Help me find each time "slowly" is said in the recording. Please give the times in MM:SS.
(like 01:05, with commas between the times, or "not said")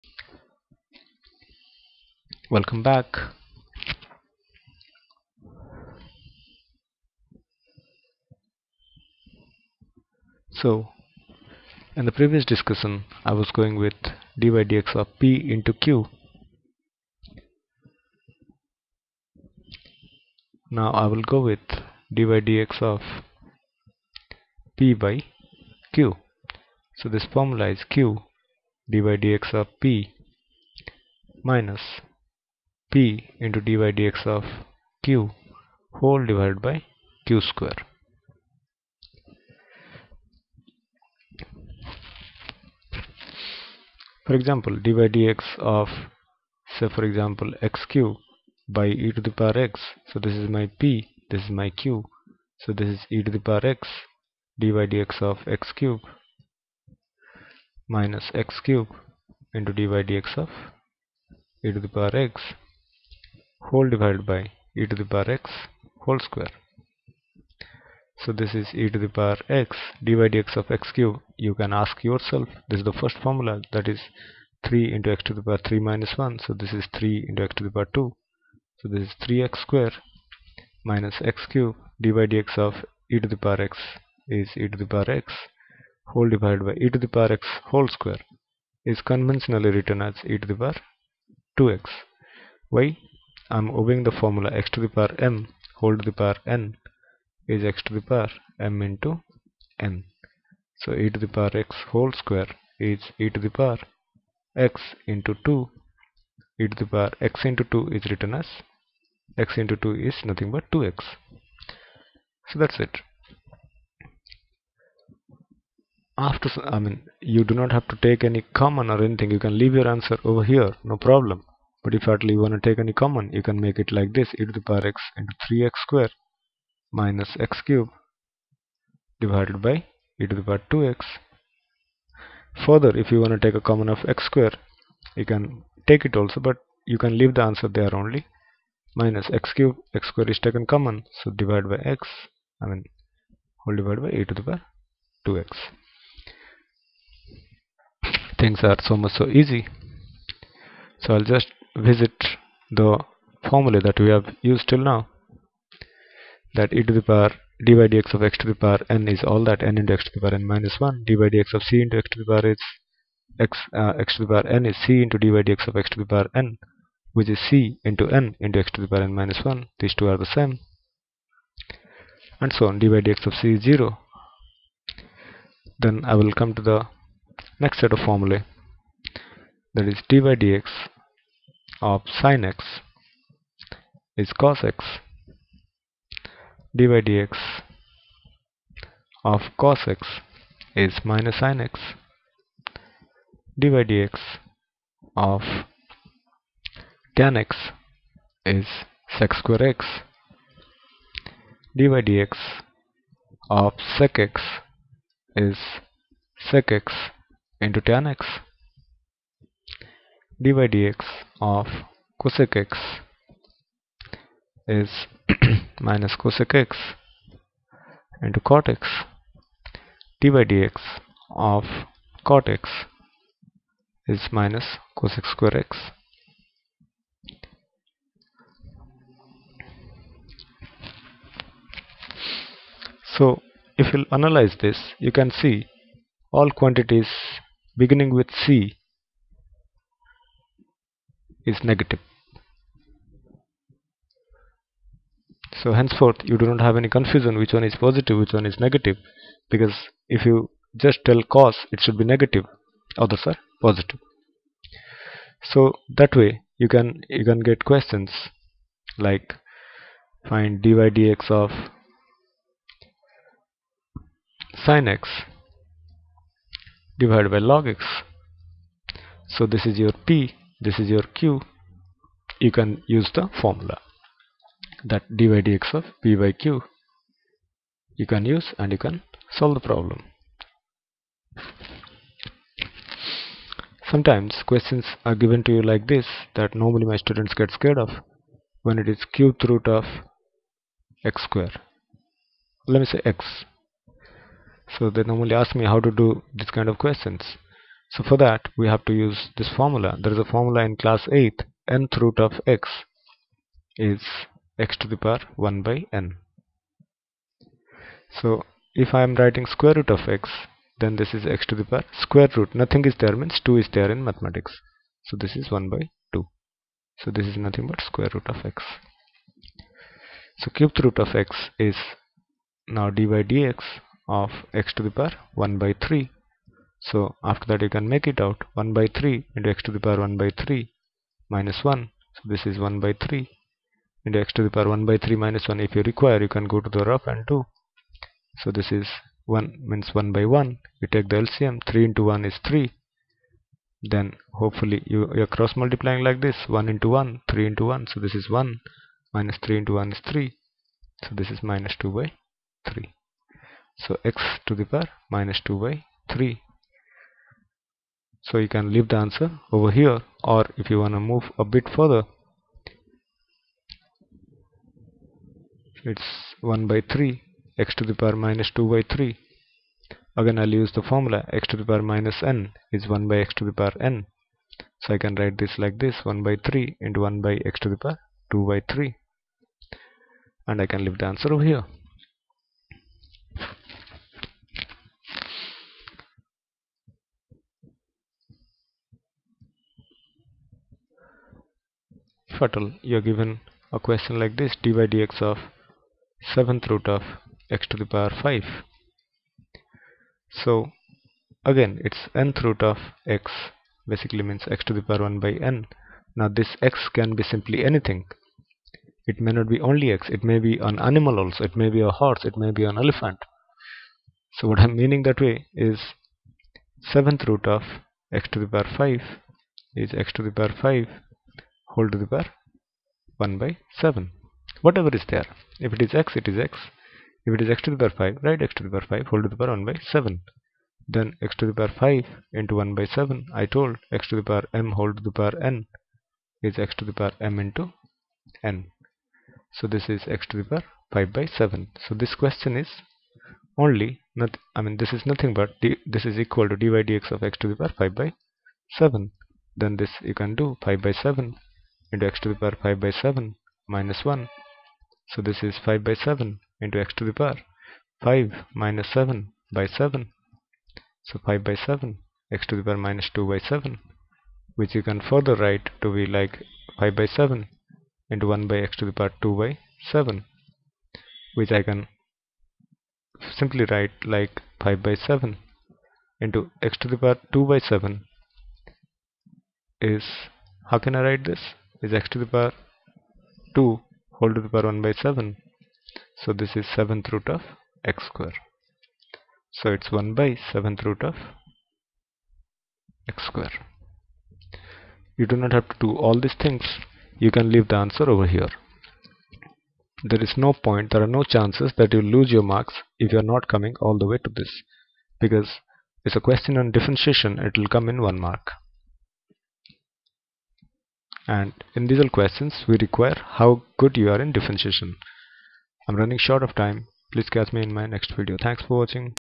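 not said.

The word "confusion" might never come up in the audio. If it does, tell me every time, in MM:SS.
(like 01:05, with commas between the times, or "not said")
04:06.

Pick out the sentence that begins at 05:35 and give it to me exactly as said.
If you require you can go to the rough and 2.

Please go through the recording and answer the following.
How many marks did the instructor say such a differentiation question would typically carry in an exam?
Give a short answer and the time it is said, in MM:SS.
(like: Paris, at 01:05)
1, at 08:28.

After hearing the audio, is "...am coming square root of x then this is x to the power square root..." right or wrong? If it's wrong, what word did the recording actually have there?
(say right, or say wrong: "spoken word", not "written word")
wrong: "writing", not "coming".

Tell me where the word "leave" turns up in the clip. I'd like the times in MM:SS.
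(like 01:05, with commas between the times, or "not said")
01:59, 02:17, 05:58, 06:20, 08:17.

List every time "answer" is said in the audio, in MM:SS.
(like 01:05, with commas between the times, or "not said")
01:59, 02:17, 05:58, 06:21, 08:17.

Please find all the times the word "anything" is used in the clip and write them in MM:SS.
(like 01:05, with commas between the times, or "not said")
01:59, 06:47.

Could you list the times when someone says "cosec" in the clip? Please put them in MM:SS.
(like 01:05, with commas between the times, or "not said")
03:32, 03:36, 03:45.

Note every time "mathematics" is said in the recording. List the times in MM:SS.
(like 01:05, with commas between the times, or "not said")
05:14.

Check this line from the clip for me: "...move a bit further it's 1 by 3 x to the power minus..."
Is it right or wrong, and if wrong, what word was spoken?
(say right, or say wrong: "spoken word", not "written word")
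right.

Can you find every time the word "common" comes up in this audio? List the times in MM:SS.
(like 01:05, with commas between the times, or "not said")
01:58, 02:02, 02:13, 02:20.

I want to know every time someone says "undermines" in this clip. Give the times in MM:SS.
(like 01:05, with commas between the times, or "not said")
not said.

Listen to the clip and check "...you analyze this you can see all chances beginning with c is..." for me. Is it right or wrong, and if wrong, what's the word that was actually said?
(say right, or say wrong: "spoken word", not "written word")
wrong: "quantities", not "chances".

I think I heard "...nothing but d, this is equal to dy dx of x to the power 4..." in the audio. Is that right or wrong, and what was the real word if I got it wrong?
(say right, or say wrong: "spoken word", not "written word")
wrong: "5", not "4".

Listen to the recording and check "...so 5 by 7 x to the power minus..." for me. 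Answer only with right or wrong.
right.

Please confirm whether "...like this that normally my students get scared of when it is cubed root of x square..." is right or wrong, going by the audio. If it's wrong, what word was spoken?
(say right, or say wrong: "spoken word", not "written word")
right.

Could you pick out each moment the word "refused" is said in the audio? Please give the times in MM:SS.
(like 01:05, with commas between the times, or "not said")
not said.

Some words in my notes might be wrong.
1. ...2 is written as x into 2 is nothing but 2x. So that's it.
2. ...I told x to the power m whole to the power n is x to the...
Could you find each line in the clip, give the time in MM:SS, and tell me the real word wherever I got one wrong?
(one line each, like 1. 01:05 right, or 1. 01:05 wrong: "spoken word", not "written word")
1. 01:47 right
2. 07:13 right.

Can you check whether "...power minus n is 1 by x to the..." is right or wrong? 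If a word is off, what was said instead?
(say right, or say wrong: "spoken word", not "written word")
right.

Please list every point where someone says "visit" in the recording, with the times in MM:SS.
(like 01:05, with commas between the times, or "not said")
02:31.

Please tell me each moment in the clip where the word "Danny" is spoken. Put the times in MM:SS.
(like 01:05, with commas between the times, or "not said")
not said.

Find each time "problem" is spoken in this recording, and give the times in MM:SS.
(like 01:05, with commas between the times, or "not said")
02:00, 04:39.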